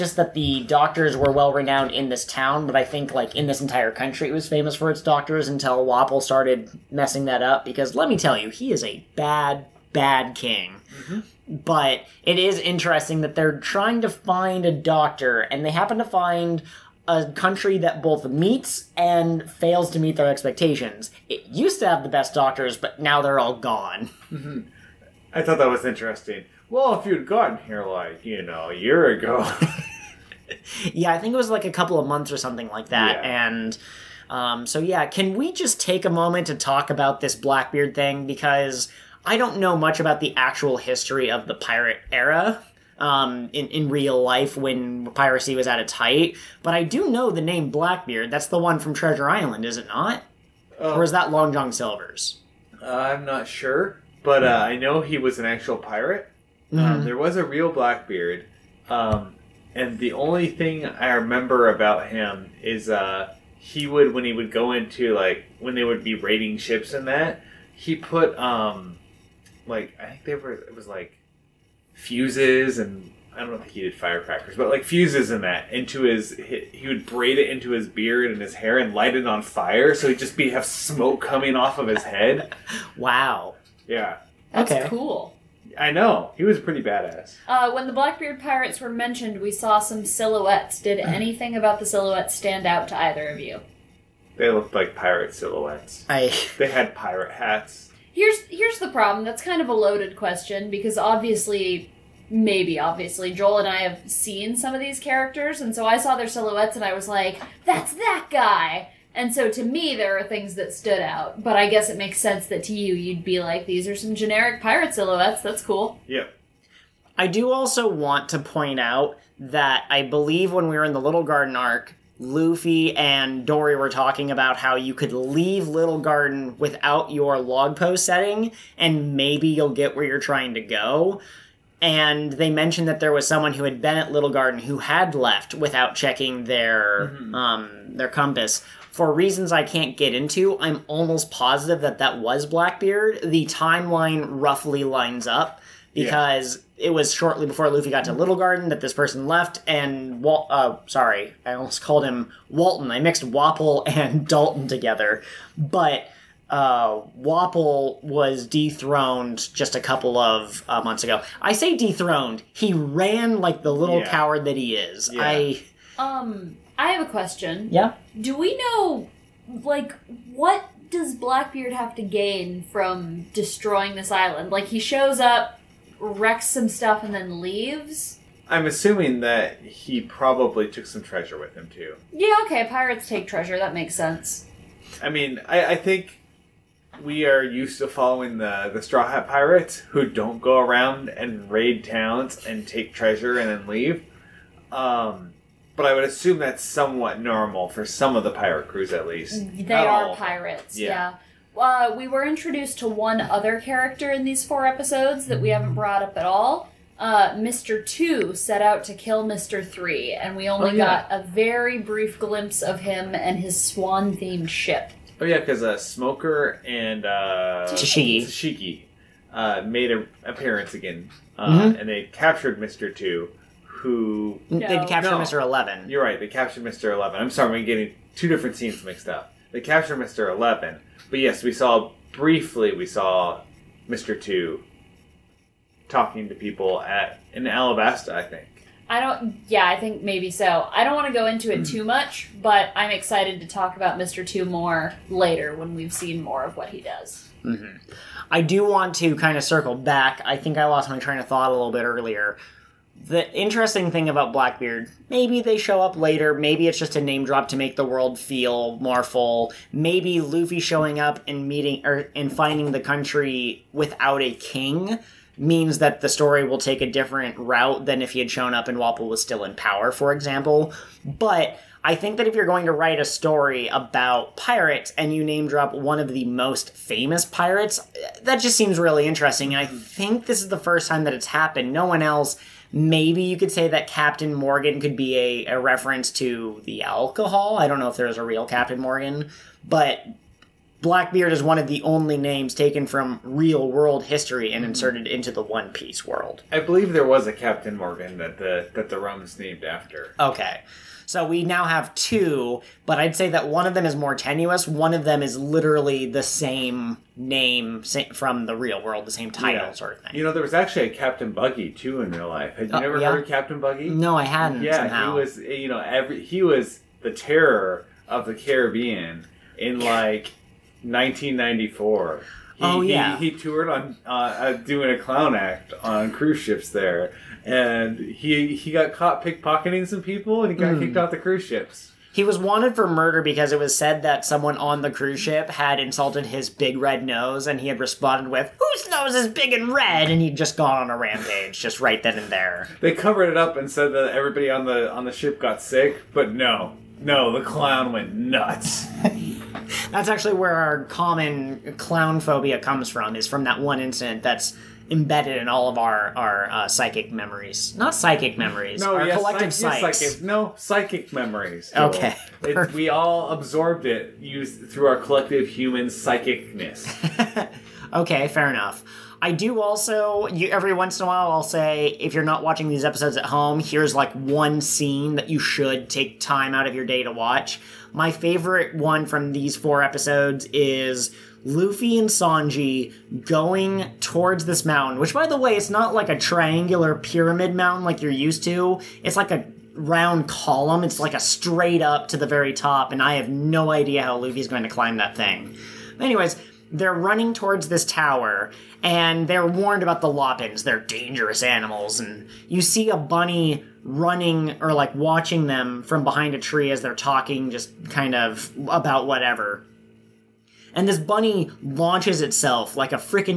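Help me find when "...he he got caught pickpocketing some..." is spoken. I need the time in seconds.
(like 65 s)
327 s.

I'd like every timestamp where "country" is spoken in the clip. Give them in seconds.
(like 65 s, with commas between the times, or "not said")
3 s, 17 s, 262 s.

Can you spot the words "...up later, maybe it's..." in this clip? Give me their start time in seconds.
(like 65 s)
255 s.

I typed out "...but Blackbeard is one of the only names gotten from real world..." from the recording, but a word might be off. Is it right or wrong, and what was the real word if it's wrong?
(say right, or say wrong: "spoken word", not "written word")
wrong: "taken", not "gotten".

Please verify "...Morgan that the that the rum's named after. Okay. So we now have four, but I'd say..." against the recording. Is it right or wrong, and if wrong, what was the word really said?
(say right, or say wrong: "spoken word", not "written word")
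wrong: "two", not "four".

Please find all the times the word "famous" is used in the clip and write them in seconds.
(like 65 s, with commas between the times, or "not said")
4 s, 276 s.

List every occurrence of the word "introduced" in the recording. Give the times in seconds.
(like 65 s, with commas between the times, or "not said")
202 s.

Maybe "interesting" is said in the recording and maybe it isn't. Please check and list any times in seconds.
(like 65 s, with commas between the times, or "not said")
12 s, 25 s, 253 s, 279 s.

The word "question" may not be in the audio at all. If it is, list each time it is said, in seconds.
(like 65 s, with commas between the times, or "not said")
100 s, 167 s.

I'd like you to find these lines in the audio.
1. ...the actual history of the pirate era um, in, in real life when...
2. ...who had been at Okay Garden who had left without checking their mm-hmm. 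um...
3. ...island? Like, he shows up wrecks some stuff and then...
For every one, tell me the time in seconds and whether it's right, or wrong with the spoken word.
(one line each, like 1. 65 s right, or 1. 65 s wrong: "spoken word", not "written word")
1. 40 s right
2. 133 s wrong: "Little", not "Okay"
3. 174 s right.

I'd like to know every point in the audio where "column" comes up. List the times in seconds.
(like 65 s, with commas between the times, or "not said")
390 s.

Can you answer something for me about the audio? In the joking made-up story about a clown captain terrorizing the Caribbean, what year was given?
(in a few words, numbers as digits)
1994.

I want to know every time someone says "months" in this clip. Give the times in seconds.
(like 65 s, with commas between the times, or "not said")
32 s, 160 s.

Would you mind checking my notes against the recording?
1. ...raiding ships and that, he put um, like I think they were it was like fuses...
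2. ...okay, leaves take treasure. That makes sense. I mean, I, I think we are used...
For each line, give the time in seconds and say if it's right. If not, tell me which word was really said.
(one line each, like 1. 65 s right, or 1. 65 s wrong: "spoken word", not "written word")
1. 66 s right
2. 182 s wrong: "pirates", not "leaves".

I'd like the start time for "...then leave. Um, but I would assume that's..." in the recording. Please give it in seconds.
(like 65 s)
193 s.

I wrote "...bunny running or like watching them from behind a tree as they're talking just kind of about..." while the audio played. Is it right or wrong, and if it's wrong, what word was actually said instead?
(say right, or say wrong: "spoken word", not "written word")
right.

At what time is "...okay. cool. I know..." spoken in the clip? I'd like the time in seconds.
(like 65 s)
84 s.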